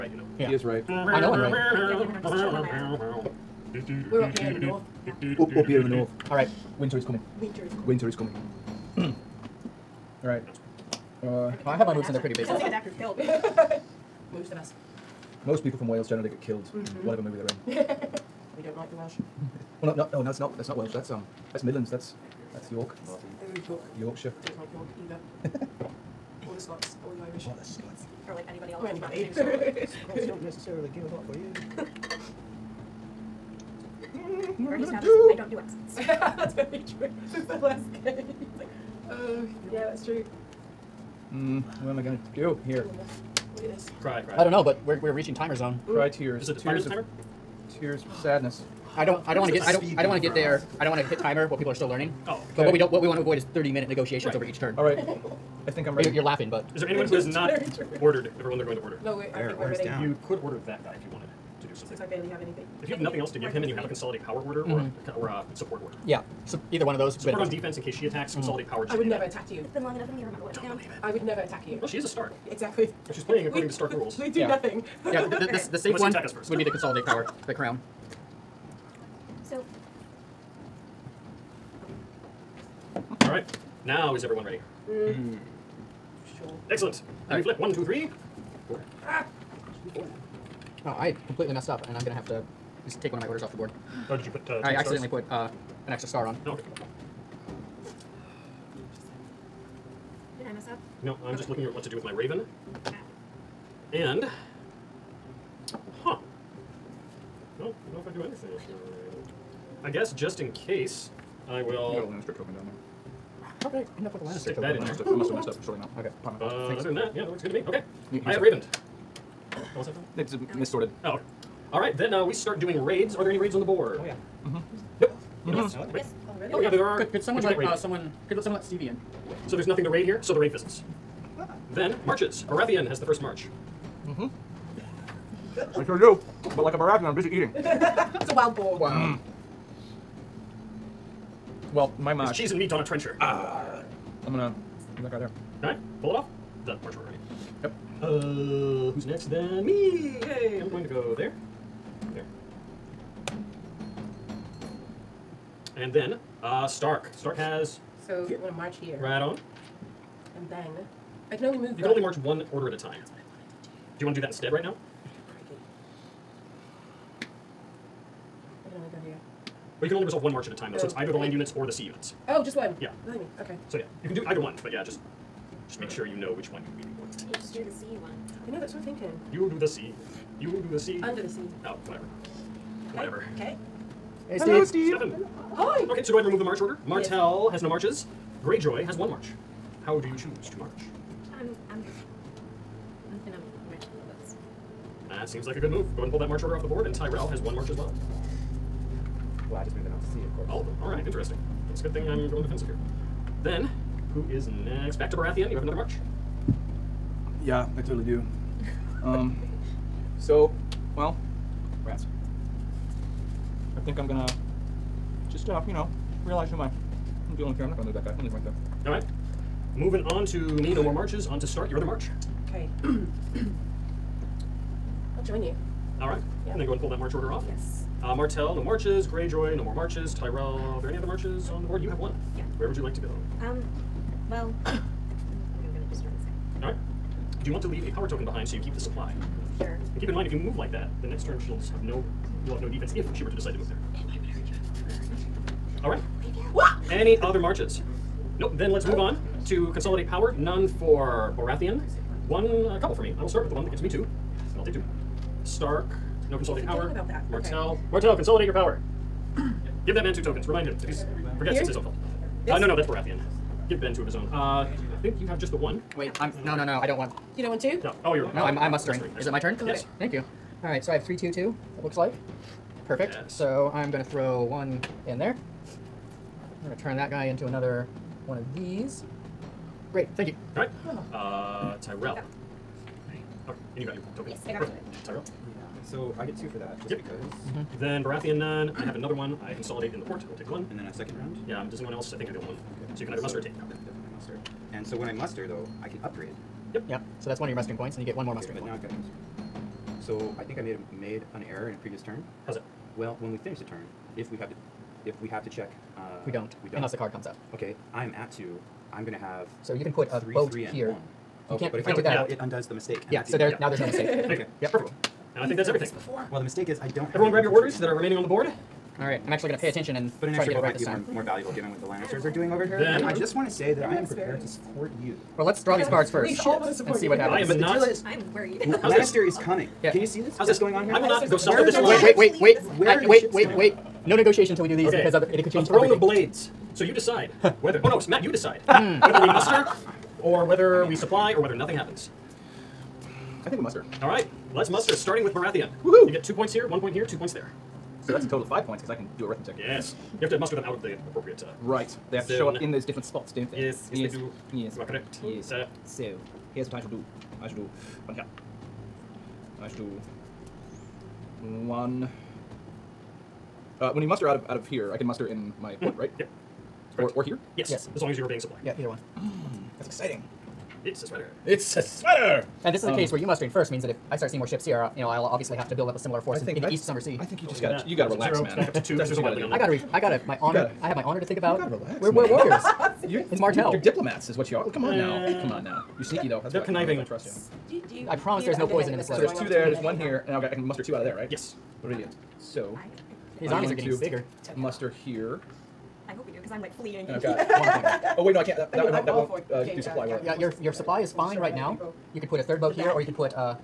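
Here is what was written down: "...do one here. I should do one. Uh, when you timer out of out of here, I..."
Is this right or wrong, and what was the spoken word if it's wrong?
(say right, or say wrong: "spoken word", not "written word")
wrong: "muster", not "timer".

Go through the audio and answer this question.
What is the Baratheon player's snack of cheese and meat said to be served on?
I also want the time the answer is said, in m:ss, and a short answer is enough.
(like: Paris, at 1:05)
a trencher, at 2:22.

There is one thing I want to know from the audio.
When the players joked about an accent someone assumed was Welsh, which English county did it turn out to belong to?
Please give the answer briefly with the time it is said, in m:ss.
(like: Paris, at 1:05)
Yorkshire, at 0:23.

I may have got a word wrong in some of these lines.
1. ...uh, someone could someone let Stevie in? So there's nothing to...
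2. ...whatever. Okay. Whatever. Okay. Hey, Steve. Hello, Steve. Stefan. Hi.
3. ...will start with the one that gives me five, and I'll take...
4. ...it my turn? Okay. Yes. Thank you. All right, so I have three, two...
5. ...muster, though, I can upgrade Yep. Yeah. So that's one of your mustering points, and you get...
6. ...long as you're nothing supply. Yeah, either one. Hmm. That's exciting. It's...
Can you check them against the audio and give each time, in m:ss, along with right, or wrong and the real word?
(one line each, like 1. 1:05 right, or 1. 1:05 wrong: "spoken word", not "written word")
1. 2:07 right
2. 3:01 right
3. 4:13 wrong: "two", not "five"
4. 4:29 right
5. 4:55 right
6. 6:08 wrong: "obeying", not "nothing".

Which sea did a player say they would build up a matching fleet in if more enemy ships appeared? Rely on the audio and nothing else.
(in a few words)
East Summer Sea.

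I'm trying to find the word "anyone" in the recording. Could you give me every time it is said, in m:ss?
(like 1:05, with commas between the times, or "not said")
0:56, 4:51.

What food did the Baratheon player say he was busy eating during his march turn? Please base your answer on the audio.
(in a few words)
wild boar.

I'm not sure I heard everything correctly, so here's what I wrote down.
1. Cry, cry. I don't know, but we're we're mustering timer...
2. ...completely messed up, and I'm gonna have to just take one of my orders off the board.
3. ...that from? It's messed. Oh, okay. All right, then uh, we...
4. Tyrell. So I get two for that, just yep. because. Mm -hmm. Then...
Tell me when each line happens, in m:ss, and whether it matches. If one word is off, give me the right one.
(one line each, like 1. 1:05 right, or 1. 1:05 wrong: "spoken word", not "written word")
1. 0:44 wrong: "reaching", not "mustering"
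2. 1:31 right
3. 1:59 wrong: "missorted", not "messed"
4. 4:45 right.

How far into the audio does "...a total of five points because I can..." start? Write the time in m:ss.
5:48.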